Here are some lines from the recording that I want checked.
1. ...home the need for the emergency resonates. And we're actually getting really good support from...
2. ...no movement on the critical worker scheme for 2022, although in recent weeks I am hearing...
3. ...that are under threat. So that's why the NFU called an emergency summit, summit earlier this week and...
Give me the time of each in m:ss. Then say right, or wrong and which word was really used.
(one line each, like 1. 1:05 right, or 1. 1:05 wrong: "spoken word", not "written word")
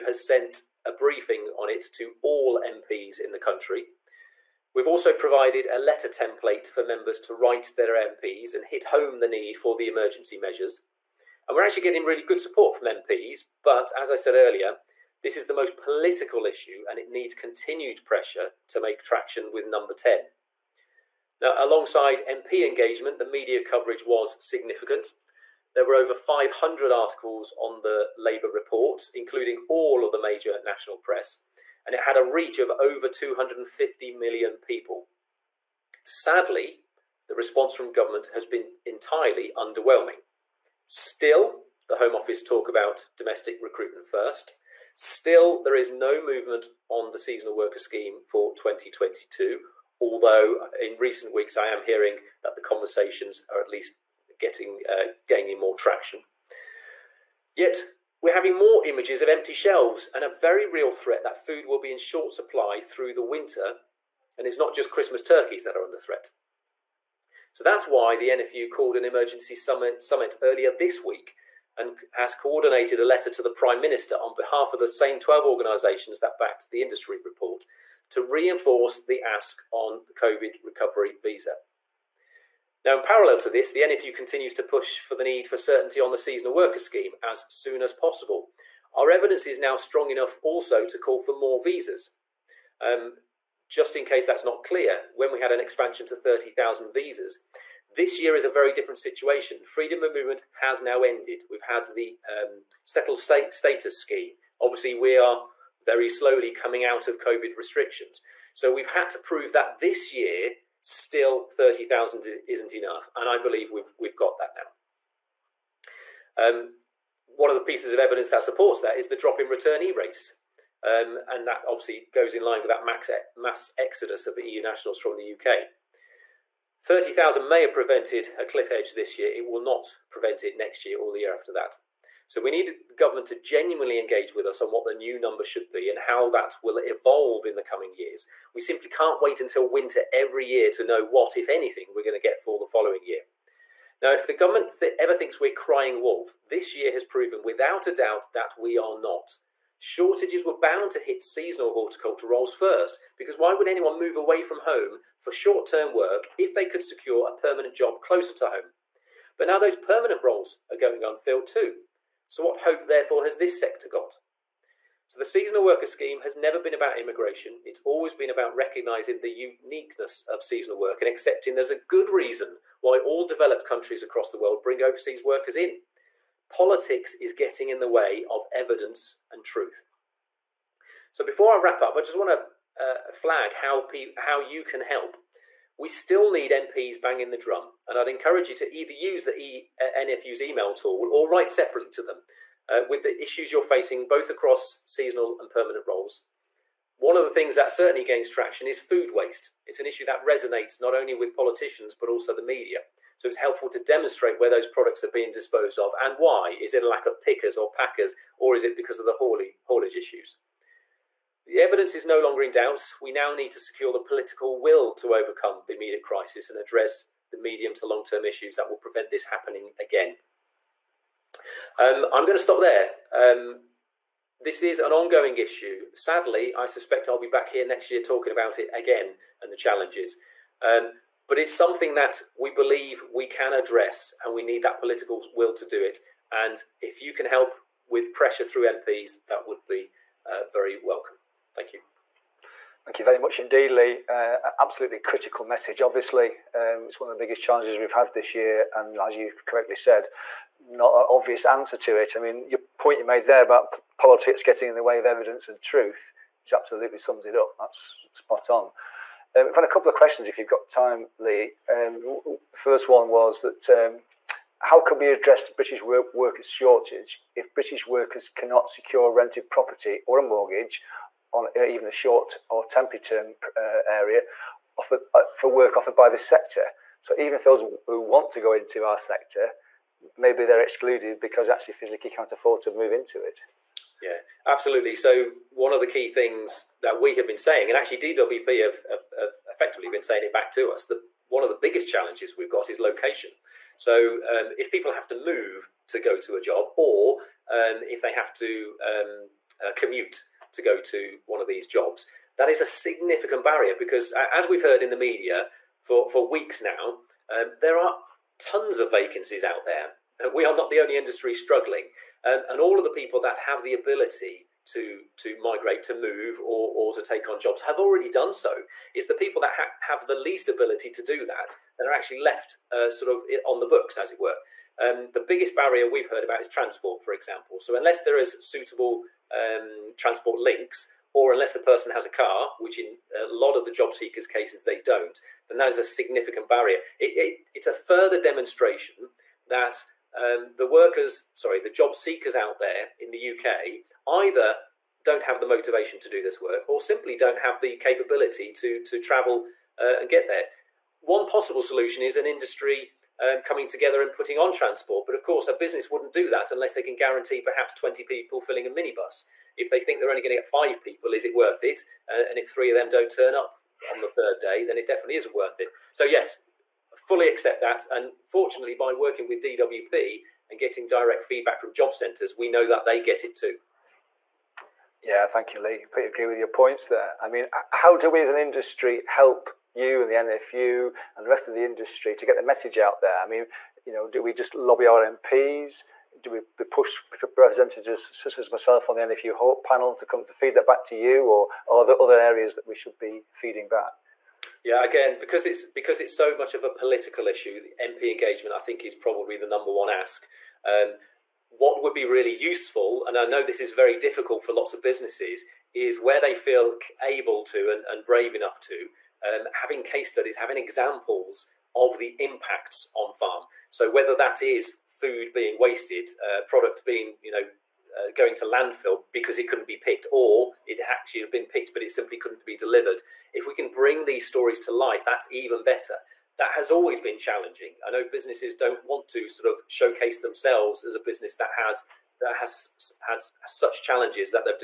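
1. 0:08 wrong: "measures", not "resonates"
2. 0:45 wrong: "seasonal", not "critical"
3. 1:05 right.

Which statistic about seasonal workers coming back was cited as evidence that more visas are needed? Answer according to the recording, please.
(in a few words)
returnee rates.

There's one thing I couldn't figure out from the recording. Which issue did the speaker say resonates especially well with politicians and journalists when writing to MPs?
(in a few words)
food waste.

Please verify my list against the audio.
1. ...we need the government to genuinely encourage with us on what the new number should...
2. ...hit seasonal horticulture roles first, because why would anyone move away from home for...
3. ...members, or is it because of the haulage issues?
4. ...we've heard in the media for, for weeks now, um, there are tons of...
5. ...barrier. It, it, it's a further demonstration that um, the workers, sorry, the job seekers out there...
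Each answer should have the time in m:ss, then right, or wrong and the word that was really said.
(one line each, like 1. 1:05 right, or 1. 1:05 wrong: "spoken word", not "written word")
1. 2:12 wrong: "engage", not "encourage"
2. 2:30 right
3. 3:27 wrong: "packers", not "members"
4. 5:04 right
5. 5:36 right.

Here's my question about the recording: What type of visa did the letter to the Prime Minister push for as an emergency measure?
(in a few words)
COVID recovery visa.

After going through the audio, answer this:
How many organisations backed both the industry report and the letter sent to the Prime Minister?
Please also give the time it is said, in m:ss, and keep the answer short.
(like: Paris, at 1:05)
12, at 1:15.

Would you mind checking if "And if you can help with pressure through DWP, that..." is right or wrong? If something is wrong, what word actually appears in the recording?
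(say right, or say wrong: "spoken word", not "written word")
wrong: "MPs", not "DWP".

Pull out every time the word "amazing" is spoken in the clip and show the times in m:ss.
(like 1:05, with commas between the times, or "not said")
not said.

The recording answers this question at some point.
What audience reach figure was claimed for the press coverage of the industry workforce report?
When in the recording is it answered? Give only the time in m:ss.
0:32.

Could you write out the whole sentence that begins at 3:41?
Um, I'm going to stop there.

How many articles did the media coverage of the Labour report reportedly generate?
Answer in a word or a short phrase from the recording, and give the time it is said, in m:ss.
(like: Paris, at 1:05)
over 500, at 0:25.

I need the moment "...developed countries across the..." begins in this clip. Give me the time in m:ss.
2:53.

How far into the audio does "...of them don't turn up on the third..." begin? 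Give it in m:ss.
6:02.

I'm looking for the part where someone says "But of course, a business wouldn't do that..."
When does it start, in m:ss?
5:55.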